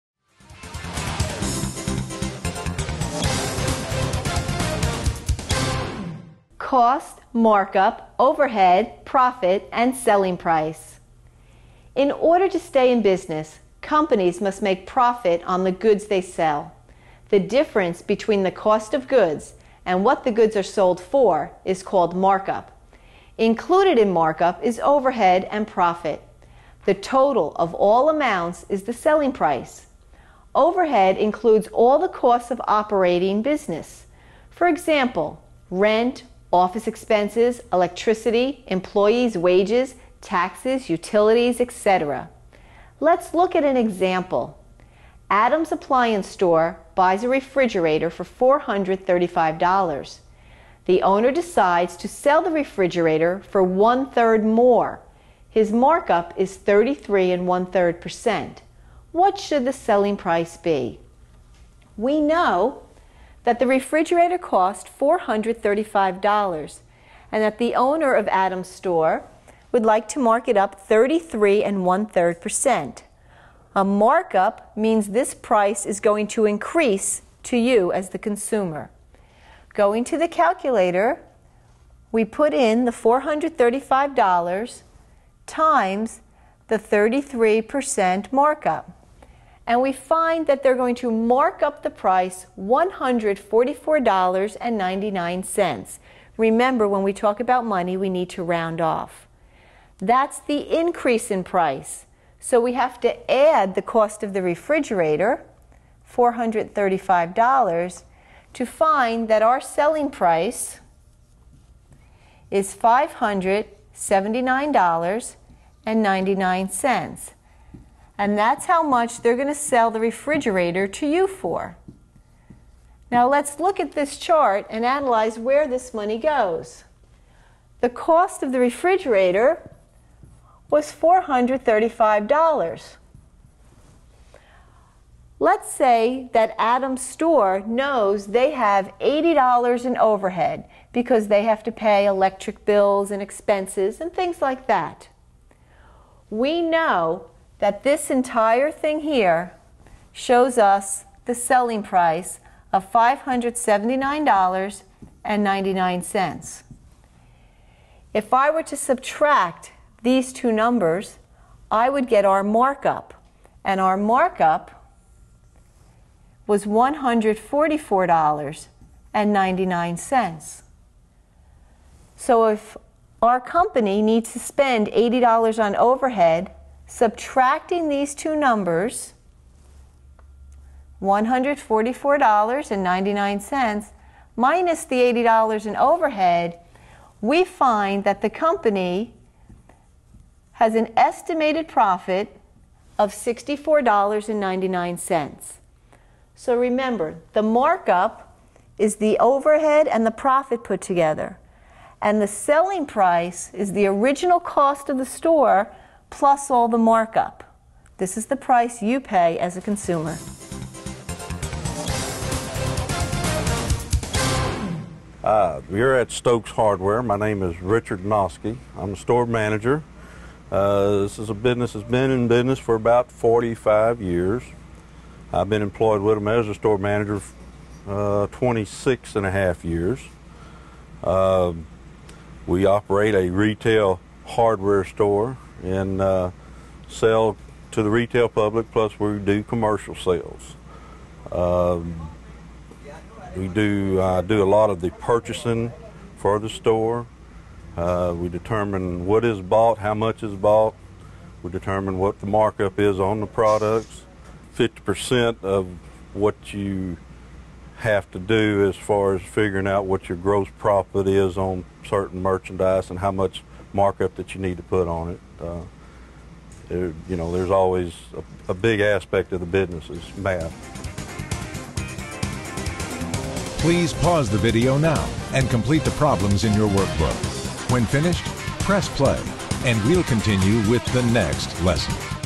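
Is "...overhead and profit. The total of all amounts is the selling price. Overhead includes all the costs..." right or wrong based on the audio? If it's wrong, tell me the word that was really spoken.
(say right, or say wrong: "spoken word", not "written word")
right.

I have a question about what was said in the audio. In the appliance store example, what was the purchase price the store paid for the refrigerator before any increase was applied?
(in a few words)
$435.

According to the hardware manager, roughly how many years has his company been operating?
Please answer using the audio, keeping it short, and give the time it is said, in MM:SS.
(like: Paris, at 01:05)
45 years, at 03:42.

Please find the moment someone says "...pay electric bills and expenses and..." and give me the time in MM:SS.
02:21.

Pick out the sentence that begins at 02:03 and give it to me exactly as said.
Now let's look at this chart and analyze where this money goes.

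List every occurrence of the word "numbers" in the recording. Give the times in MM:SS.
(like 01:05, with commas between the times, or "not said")
02:40, 02:58.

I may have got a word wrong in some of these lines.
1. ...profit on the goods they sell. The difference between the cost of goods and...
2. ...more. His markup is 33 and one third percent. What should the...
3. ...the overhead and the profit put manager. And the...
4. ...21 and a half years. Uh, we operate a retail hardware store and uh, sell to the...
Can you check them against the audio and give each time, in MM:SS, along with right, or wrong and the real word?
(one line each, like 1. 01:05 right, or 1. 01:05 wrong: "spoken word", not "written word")
1. 00:14 right
2. 00:54 right
3. 03:18 wrong: "together", not "manager"
4. 03:48 wrong: "26", not "21".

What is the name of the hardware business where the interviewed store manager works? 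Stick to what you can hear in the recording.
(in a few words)
Stokes Hardware.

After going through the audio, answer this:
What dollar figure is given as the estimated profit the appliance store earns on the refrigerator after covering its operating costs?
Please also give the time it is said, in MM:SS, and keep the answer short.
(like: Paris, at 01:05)
$64.99, at 03:13.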